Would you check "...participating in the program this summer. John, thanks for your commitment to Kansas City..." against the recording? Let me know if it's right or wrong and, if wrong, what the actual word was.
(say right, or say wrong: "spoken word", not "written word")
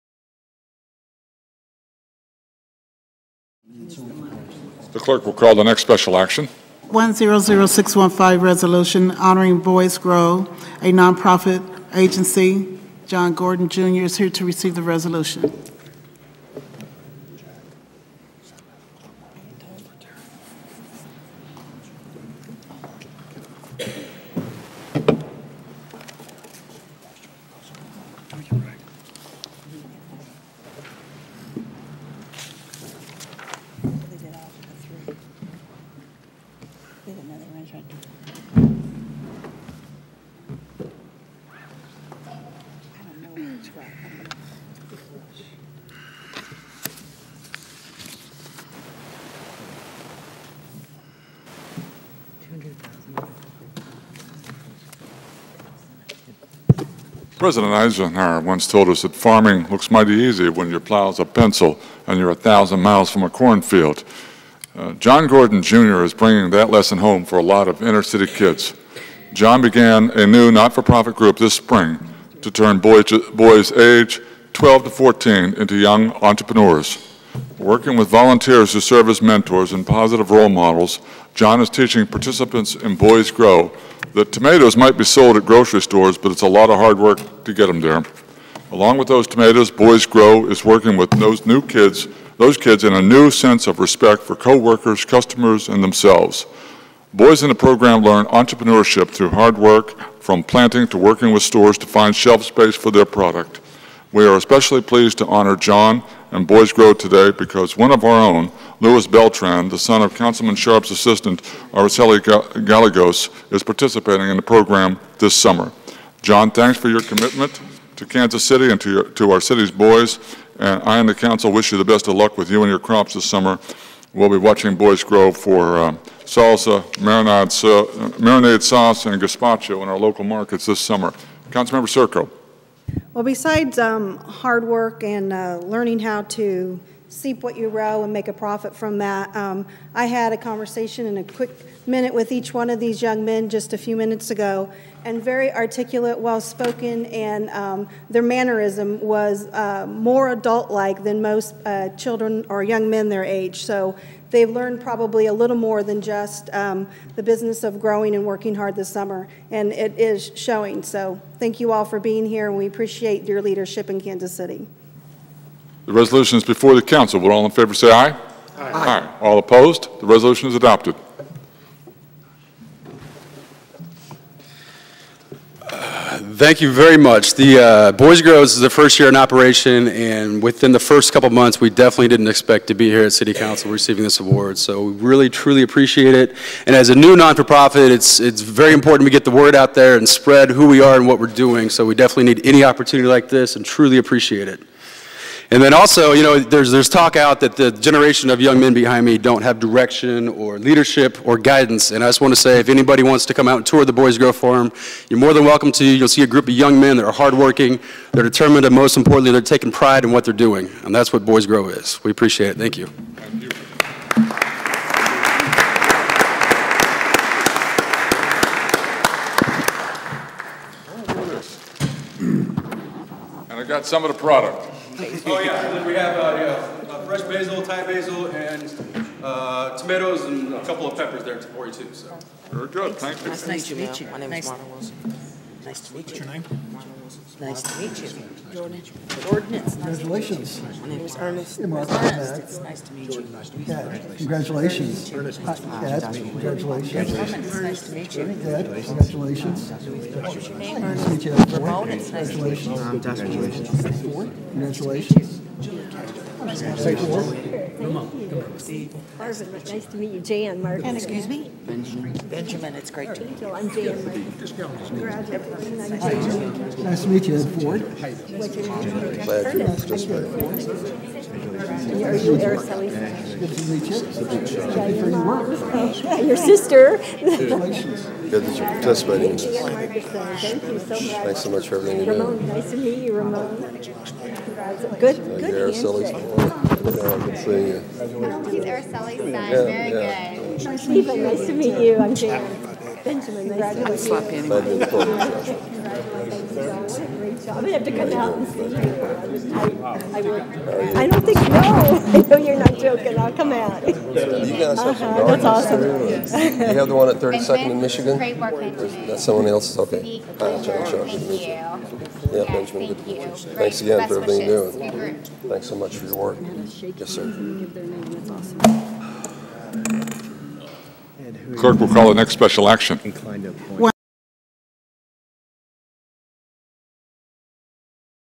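right.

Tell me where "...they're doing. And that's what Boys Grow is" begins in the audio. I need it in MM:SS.
03:30.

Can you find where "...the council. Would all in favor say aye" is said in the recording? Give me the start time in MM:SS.
02:46.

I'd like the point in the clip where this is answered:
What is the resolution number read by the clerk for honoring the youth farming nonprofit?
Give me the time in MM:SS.
00:06.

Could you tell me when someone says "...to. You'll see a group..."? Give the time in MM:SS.
03:25.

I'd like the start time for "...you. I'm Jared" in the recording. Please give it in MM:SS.
04:51.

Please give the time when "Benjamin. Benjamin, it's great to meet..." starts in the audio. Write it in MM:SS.
04:21.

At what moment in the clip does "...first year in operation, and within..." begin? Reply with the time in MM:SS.
02:58.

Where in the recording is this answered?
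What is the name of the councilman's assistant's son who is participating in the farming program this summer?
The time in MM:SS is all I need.
01:48.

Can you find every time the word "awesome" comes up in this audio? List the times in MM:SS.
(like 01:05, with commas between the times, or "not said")
05:05, 05:18.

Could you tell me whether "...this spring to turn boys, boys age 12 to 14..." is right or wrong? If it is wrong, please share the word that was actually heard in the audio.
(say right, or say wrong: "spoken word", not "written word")
right.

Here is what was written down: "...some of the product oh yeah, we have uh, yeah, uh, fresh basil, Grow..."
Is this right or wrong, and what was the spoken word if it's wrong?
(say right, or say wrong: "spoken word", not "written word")
wrong: "Thai", not "Grow".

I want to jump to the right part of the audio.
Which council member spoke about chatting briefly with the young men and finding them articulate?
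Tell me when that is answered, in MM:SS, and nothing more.
02:11.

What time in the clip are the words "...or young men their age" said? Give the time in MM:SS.
02:32.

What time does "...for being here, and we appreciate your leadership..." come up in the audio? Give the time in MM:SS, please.
02:41.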